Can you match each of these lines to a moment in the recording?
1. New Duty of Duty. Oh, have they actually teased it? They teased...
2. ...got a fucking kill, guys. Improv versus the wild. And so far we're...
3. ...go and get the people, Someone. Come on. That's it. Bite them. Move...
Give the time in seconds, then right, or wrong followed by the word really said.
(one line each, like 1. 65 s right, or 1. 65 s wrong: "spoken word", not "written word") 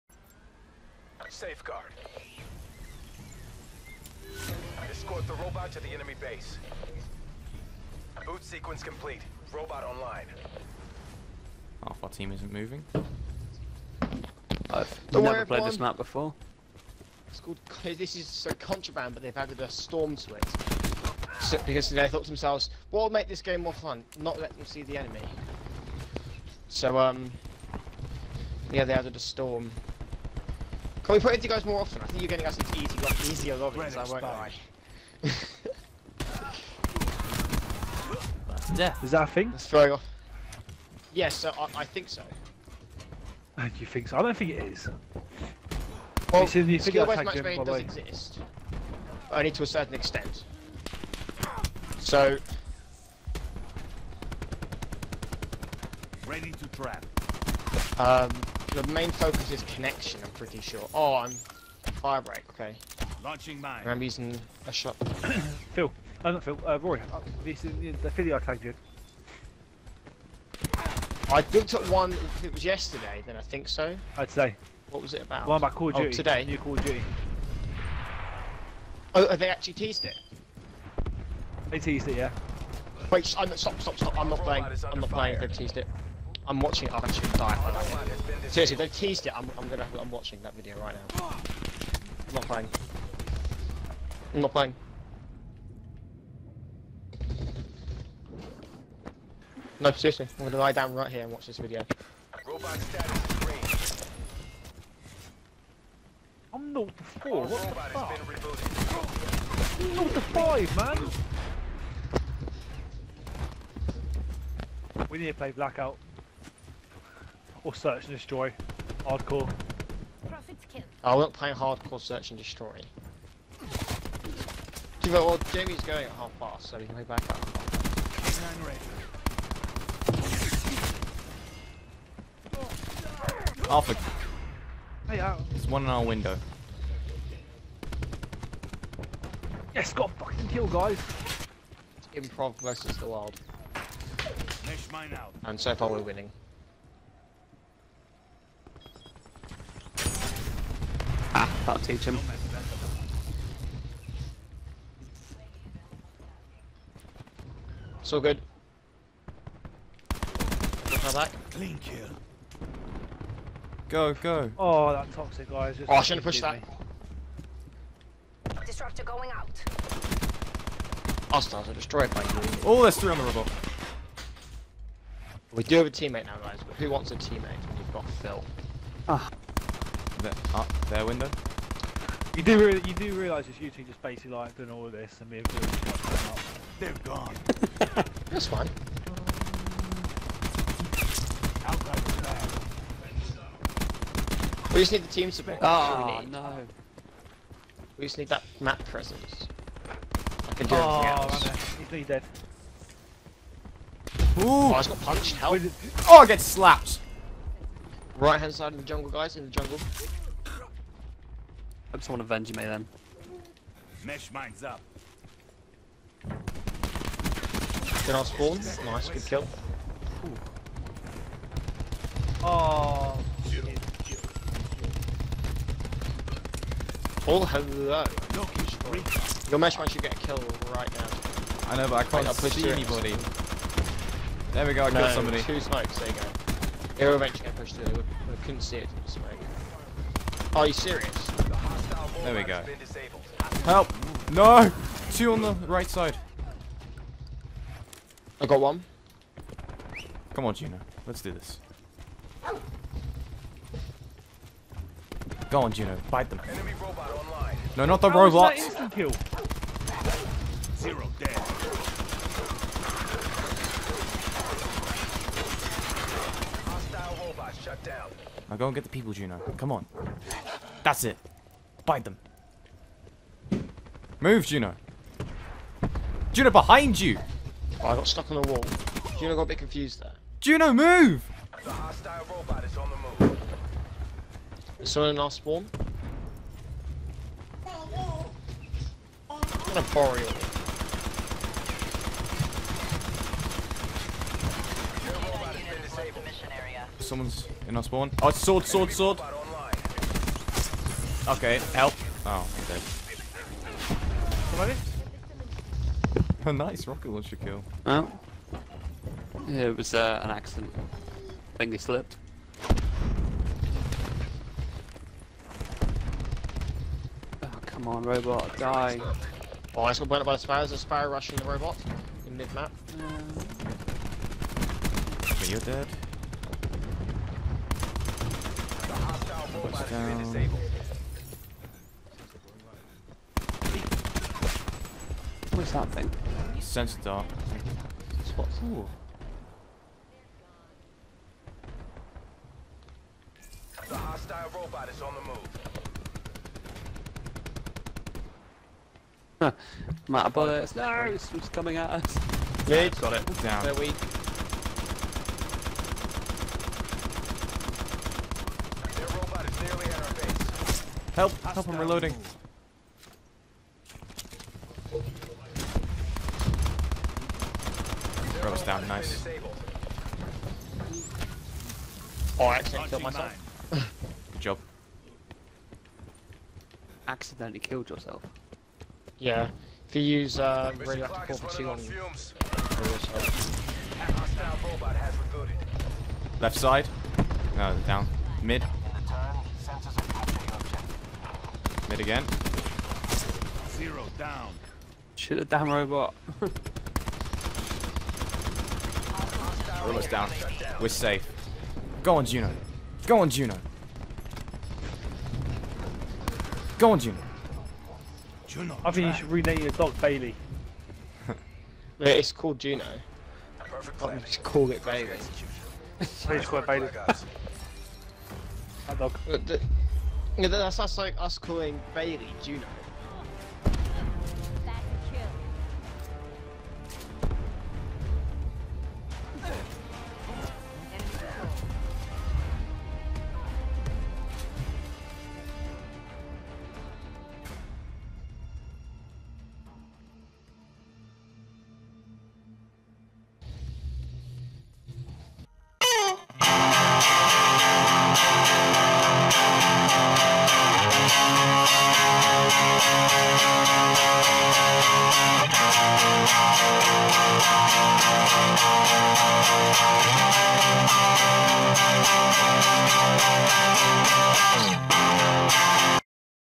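1. 76 s wrong: "Call", not "Duty"
2. 139 s right
3. 268 s wrong: "Juno", not "Someone".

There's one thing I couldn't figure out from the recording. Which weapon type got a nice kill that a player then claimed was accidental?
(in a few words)
Rocket launcher.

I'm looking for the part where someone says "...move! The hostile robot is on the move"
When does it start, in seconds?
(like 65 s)
280 s.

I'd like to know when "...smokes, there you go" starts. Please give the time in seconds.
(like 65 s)
235 s.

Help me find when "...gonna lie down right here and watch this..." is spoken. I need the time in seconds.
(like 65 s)
100 s.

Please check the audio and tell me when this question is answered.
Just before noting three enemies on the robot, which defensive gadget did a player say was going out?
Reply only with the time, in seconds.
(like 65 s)
168 s.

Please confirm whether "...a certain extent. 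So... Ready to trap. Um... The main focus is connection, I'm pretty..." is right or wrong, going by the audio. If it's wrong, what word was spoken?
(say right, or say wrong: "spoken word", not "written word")
right.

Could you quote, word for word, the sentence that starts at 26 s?
So um, yeah, they added a storm.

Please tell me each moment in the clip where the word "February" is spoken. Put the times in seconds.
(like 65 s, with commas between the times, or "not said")
not said.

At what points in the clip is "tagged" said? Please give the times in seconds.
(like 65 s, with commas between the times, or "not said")
68 s.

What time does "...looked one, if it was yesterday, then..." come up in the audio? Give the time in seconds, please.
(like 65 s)
71 s.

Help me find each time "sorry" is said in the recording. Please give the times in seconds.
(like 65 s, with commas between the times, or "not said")
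not said.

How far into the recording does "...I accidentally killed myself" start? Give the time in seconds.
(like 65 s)
372 s.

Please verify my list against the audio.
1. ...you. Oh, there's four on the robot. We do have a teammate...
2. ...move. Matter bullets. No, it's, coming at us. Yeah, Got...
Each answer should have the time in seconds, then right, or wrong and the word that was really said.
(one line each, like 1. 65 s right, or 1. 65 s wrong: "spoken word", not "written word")
1. 172 s wrong: "three", not "four"
2. 345 s right.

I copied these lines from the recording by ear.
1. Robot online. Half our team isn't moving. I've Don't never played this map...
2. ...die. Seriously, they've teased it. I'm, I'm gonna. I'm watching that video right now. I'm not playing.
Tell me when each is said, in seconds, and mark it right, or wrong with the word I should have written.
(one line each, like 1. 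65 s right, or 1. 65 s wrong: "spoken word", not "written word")
1. 9 s right
2. 86 s right.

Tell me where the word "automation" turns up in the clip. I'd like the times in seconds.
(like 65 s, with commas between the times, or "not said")
not said.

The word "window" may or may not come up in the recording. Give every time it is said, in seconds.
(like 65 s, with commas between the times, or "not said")
136 s, 181 s.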